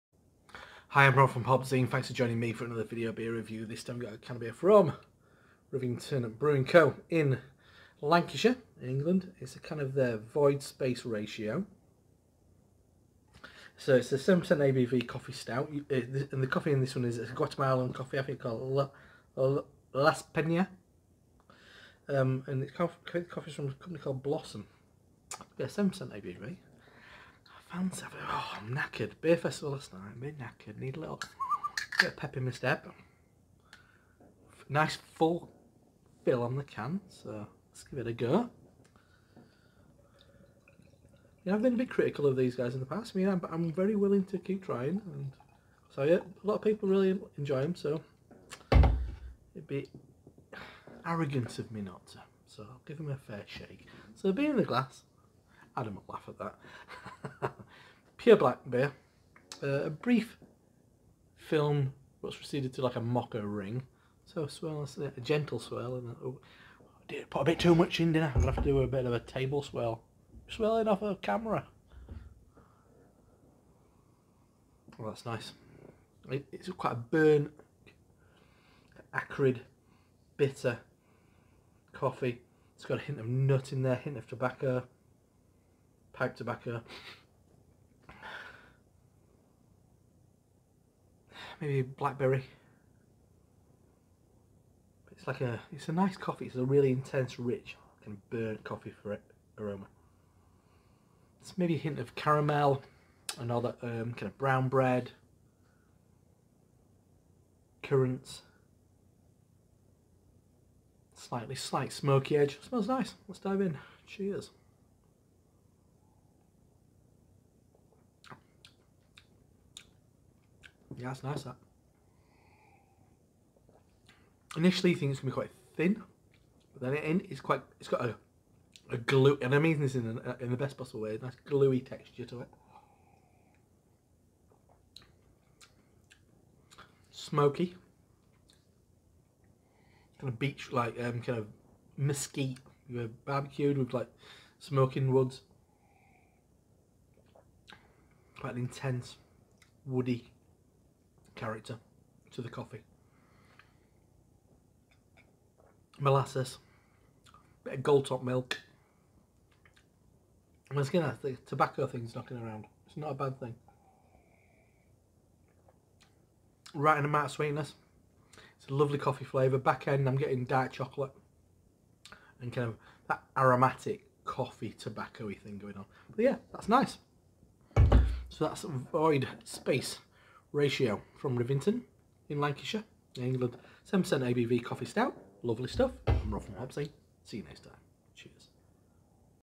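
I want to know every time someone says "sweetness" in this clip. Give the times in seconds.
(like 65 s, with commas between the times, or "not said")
167 s.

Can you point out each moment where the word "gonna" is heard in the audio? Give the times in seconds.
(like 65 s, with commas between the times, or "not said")
68 s, 125 s, 160 s.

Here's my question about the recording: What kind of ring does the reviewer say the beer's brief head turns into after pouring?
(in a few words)
Mocha ring.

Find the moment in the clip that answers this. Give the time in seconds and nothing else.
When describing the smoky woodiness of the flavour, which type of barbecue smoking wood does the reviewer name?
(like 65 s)
141 s.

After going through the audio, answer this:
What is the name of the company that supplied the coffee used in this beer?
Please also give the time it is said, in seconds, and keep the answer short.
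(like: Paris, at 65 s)
Blossom, at 24 s.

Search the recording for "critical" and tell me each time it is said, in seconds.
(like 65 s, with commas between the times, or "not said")
41 s.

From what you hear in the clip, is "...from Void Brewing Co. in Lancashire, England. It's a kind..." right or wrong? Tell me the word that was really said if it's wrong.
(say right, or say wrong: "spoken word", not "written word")
wrong: "Rivington", not "Void".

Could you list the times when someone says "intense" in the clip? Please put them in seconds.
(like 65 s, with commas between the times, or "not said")
96 s, 148 s.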